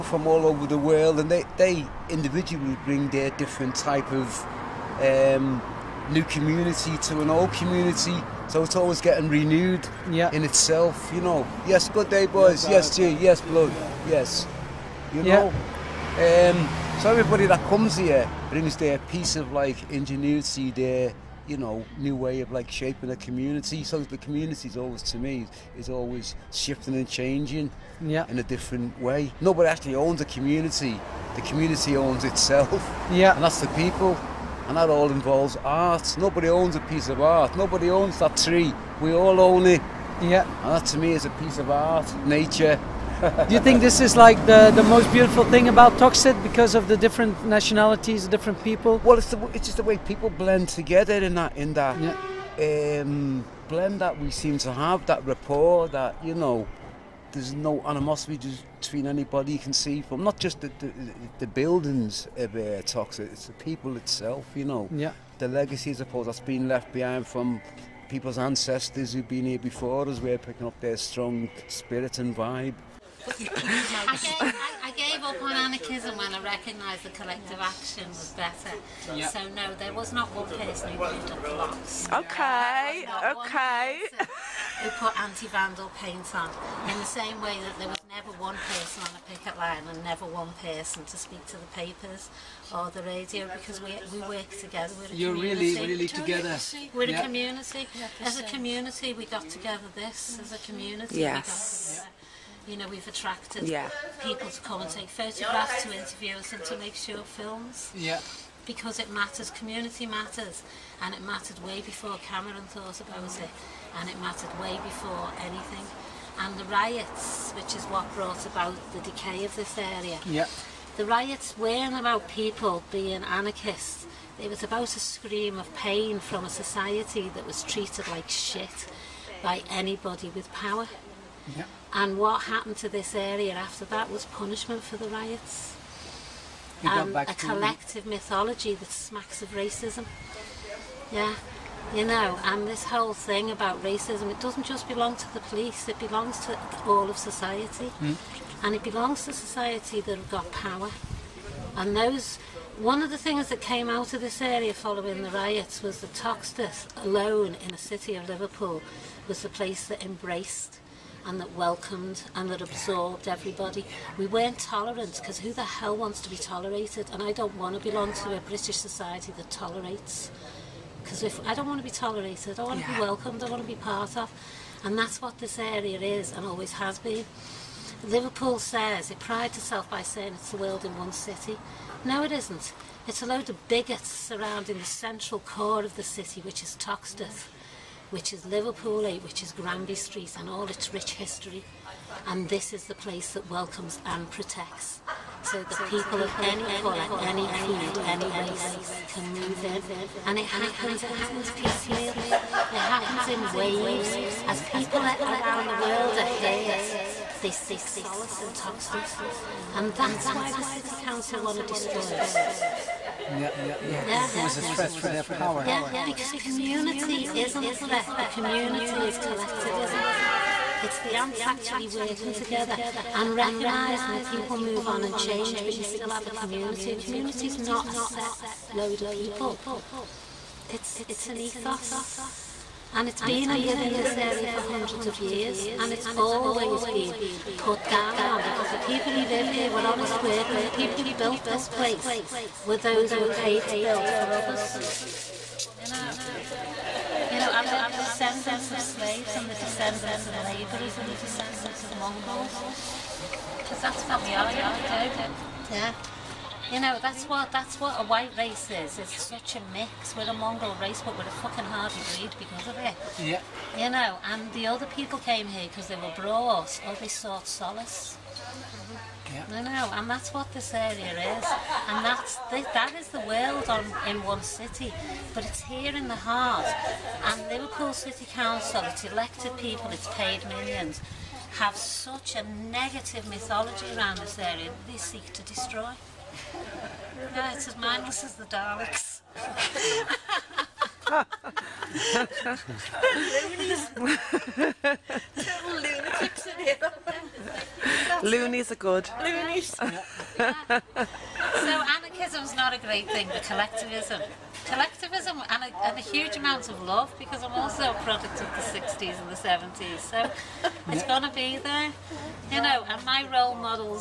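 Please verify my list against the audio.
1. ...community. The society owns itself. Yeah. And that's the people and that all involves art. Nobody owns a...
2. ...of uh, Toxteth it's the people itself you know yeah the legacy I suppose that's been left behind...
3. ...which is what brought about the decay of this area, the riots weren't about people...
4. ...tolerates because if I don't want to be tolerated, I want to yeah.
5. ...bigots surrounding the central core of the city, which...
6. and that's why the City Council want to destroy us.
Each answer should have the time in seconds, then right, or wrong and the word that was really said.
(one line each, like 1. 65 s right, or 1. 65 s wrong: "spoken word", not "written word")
1. 30 s wrong: "community", not "society"
2. 62 s right
3. 117 s right
4. 169 s right
5. 183 s right
6. 209 s right.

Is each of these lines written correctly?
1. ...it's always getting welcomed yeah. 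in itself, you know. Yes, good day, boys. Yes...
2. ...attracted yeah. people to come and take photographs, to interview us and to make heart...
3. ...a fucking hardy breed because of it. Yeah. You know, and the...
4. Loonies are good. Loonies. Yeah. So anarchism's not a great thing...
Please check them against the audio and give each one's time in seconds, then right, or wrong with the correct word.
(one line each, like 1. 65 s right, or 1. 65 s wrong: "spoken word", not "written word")
1. 8 s wrong: "renewed", not "welcomed"
2. 103 s wrong: "short", not "heart"
3. 261 s right
4. 298 s right.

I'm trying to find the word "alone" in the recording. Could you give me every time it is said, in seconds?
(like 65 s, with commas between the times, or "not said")
157 s.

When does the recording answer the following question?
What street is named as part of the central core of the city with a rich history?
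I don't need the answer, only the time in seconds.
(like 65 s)
189 s.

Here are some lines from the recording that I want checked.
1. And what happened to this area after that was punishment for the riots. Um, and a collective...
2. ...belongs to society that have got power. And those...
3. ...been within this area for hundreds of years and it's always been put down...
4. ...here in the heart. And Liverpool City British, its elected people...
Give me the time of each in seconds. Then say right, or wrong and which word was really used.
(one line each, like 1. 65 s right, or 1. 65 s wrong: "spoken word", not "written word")
1. 131 s right
2. 148 s right
3. 233 s right
4. 275 s wrong: "Council", not "British".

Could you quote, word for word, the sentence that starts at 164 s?
We weren't tolerant because who the hell wants to be tolerated?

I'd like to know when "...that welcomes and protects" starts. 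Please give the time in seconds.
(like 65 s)
193 s.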